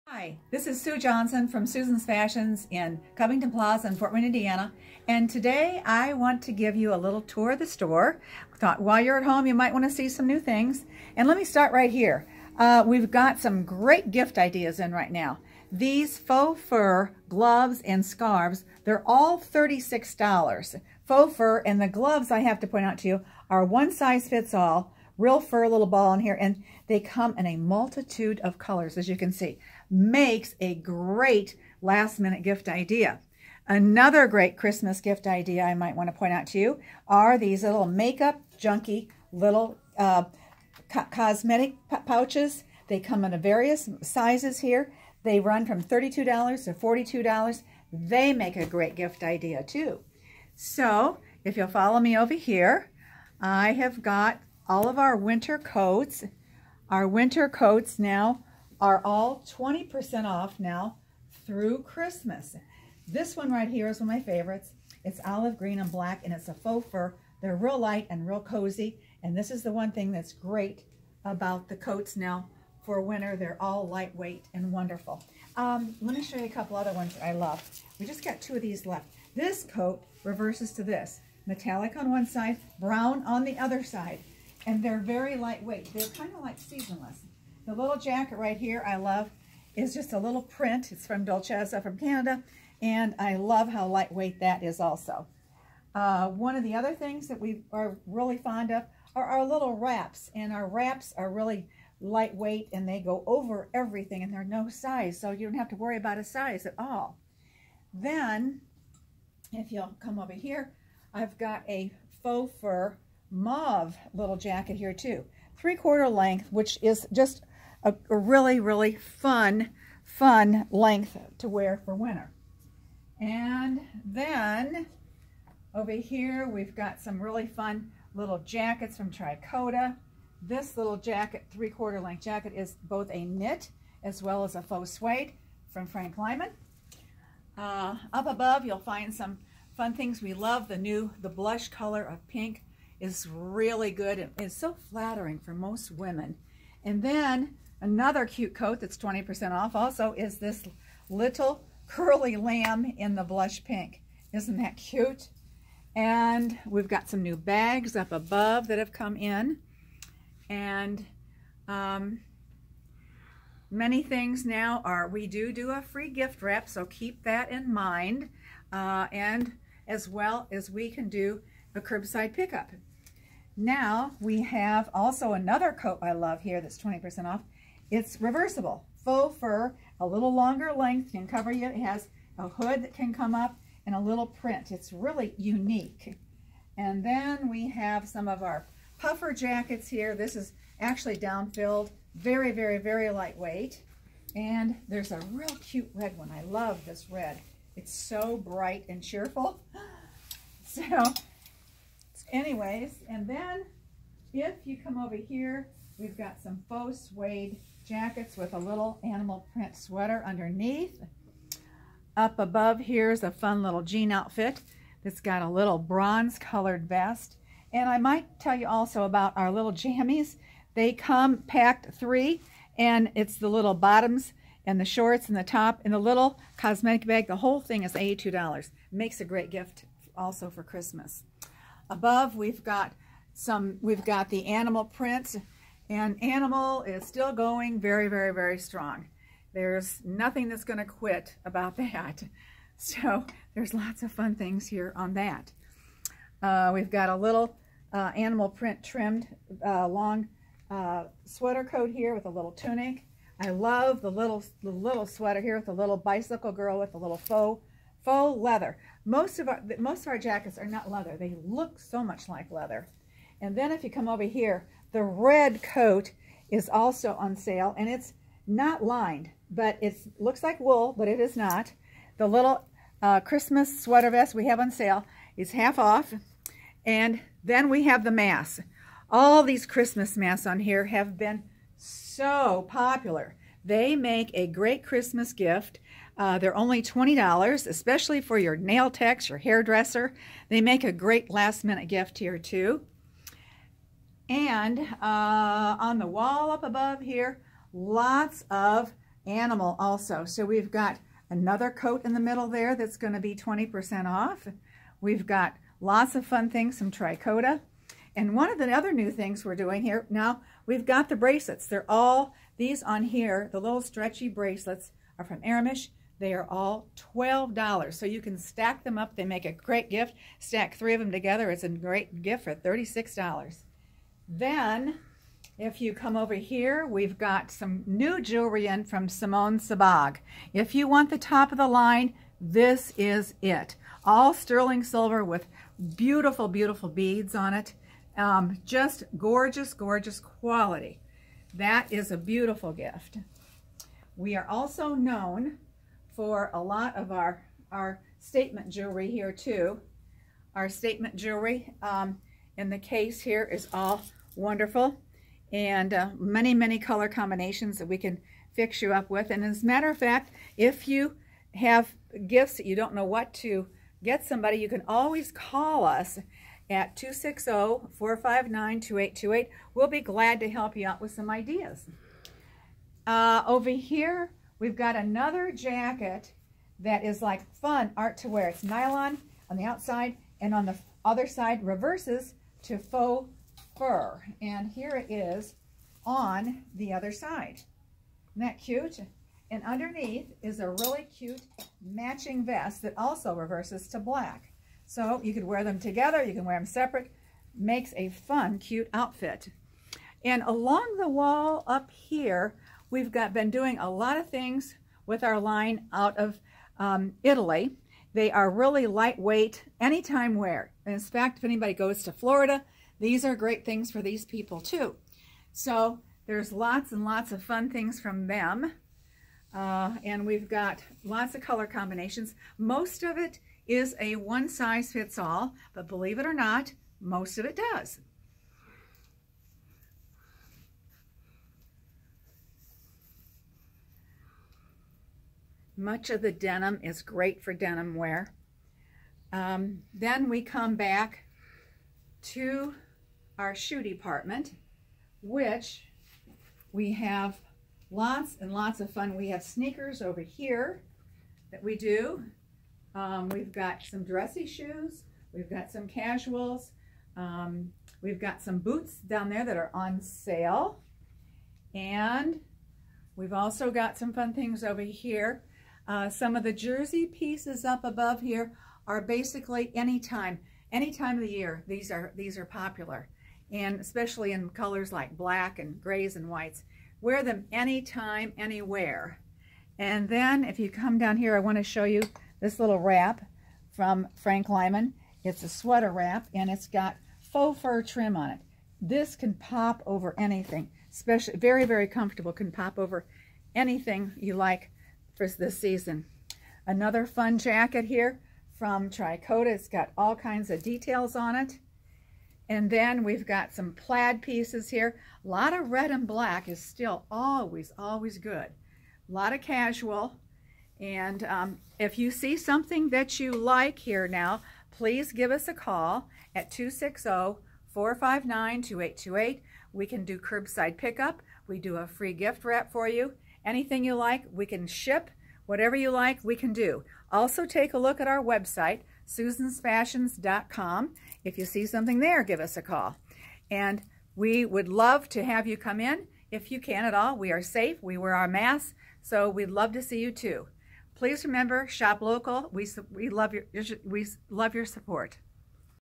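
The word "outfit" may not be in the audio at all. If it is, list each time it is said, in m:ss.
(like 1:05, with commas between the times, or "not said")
3:34, 6:38.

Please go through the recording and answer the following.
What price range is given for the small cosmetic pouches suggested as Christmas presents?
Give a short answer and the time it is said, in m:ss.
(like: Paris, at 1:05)
$32 to $42, at 0:45.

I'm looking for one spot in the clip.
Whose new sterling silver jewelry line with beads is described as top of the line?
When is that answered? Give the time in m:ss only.
5:29.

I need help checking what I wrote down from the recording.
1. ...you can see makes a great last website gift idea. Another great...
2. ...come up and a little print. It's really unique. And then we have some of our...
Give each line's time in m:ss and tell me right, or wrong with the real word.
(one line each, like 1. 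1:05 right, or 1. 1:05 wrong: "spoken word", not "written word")
1. 0:29 wrong: "minute", not "website"
2. 3:03 right.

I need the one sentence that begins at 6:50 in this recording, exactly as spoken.
In fact, if anybody goes to Florida, these are great things for these people too.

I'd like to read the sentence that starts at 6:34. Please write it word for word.
So you could wear them together, you can wear them separate.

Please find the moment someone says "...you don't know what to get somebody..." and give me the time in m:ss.
6:02.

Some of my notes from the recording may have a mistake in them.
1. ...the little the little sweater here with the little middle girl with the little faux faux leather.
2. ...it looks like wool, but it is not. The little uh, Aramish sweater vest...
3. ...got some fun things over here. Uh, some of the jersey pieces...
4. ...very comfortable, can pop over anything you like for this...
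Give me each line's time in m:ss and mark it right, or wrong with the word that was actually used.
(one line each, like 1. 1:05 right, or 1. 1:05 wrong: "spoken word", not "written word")
1. 4:14 wrong: "bicycle", not "middle"
2. 4:29 wrong: "Christmas", not "Aramish"
3. 7:43 right
4. 8:11 right.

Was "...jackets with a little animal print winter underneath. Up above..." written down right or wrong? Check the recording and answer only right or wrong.
wrong.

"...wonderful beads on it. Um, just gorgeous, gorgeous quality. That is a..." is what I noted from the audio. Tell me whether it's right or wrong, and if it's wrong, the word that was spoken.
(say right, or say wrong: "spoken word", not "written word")
wrong: "beautiful", not "wonderful".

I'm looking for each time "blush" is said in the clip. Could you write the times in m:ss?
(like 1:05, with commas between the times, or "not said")
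2:21, 2:33.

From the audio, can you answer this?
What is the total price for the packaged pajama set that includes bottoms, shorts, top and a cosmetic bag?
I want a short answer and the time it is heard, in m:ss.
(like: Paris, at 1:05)
$82, at 3:47.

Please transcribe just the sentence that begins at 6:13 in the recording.
Uh, over here, we've got another jacket that is like fun art to wear.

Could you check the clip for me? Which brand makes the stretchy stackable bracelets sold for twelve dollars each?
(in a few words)
Aramish.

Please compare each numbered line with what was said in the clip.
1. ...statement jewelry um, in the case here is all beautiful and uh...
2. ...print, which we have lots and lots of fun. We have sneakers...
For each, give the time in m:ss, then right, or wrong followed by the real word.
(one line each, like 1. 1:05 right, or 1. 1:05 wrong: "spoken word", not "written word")
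1. 5:50 wrong: "wonderful", not "beautiful"
2. 7:23 wrong: "department", not "print".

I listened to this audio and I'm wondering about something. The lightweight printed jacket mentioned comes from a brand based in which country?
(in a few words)
Canada.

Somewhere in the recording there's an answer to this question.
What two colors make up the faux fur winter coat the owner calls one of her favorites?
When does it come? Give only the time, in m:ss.
1:05.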